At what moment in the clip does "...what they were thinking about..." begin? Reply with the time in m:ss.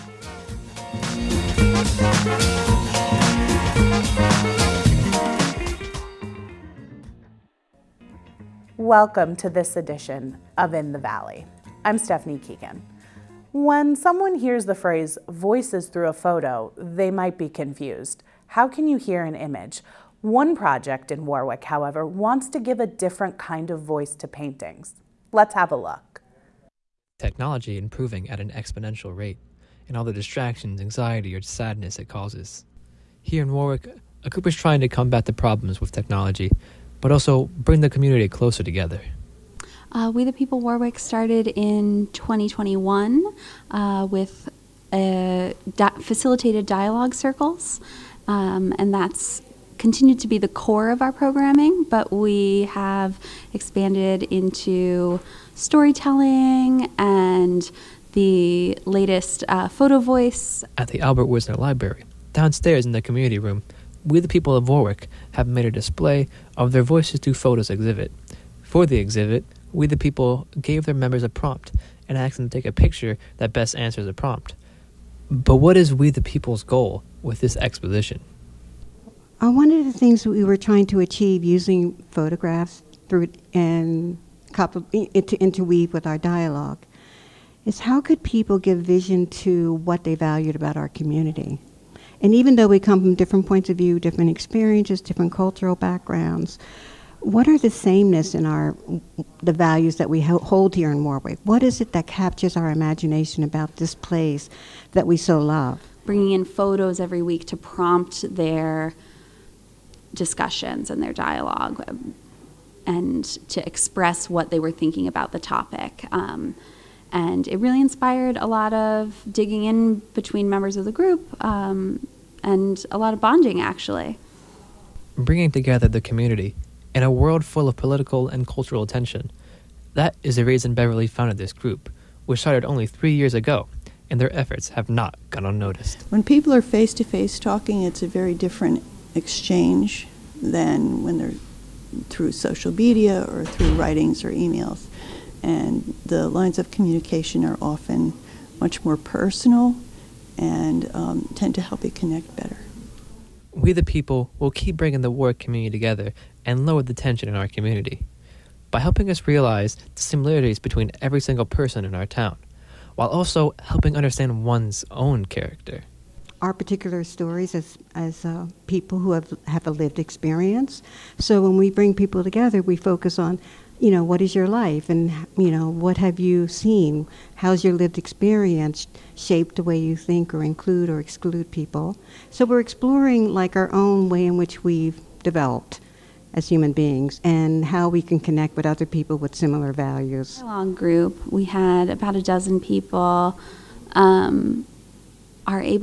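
1:54.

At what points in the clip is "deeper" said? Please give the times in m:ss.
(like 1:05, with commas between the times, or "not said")
not said.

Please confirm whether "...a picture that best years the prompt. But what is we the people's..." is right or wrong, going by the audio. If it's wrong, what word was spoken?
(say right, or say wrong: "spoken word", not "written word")
wrong: "answers", not "years".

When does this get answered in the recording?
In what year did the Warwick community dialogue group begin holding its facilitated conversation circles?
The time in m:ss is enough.
0:42.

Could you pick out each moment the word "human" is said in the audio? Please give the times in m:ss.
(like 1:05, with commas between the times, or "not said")
3:06.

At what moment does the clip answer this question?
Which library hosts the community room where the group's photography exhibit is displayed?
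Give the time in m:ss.
1:00.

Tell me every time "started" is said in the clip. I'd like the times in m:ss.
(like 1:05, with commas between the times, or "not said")
0:40, 2:12.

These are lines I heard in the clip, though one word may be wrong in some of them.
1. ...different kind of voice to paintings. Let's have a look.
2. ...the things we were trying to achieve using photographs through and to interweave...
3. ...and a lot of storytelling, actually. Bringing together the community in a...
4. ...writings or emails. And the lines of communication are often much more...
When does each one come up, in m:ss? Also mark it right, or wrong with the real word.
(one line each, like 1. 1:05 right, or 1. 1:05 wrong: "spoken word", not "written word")
1. 0:22 right
2. 1:19 right
3. 2:02 wrong: "bonding", not "storytelling"
4. 2:23 right.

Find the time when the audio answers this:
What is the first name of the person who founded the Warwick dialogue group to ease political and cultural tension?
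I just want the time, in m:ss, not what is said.
2:10.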